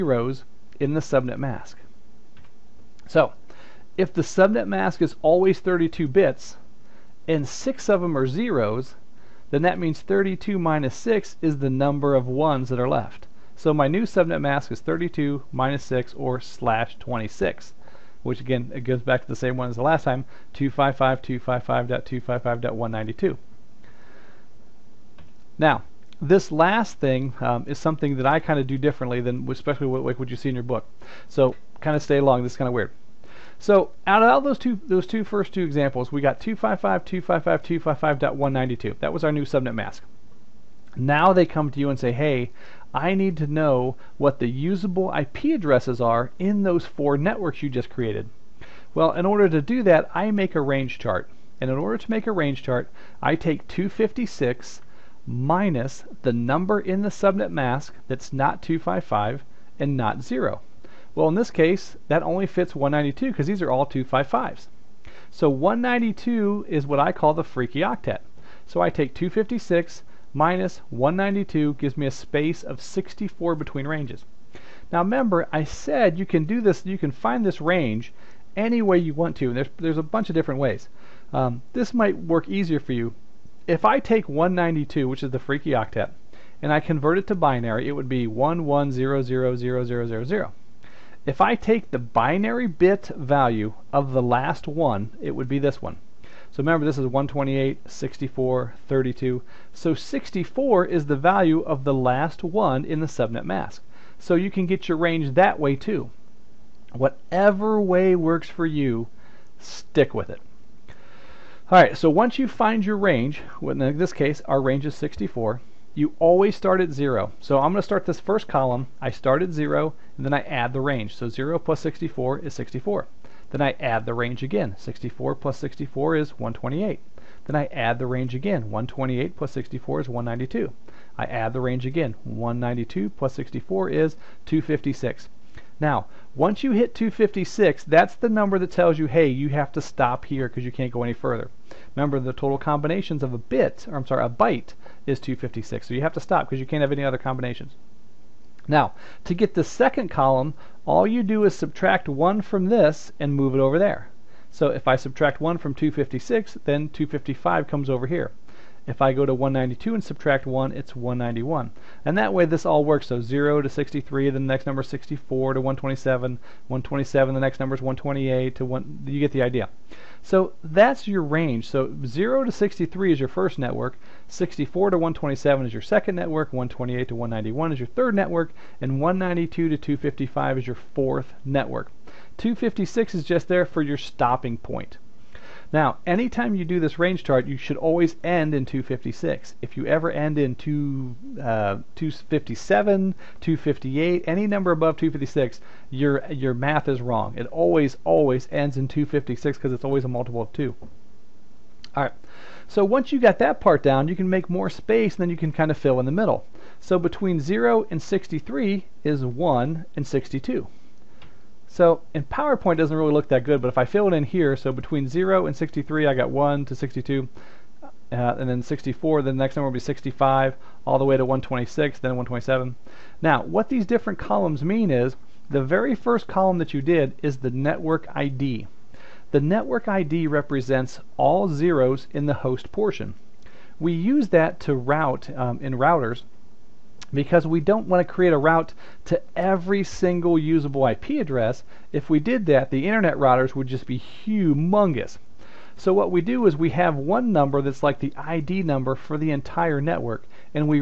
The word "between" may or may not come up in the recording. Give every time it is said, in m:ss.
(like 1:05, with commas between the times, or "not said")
1:13, 3:26, 3:34.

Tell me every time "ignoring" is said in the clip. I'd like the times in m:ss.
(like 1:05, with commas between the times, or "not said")
not said.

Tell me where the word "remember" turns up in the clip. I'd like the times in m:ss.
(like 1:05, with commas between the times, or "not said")
1:14, 1:36, 2:21.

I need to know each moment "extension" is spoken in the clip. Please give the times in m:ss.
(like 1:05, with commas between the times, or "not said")
not said.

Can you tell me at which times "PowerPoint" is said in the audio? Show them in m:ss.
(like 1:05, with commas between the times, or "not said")
3:32.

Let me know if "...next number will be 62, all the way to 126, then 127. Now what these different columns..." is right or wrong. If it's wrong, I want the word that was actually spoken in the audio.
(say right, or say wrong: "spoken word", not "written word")
wrong: "65", not "62".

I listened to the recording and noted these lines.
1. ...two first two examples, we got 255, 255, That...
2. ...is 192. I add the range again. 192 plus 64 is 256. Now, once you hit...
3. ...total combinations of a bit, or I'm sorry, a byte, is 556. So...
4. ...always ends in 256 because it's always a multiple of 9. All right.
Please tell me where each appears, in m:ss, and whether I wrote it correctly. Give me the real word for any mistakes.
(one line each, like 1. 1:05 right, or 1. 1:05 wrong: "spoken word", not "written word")
1. 0:35 right
2. 2:10 right
3. 2:22 wrong: "256", not "556"
4. 3:18 wrong: "2", not "9".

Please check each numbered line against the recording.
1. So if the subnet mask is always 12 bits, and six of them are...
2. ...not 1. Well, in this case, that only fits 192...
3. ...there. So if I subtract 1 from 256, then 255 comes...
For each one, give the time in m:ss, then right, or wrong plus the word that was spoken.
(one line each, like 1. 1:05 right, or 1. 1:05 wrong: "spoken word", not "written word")
1. 0:03 wrong: "32", not "12"
2. 0:59 wrong: "0", not "1"
3. 2:33 right.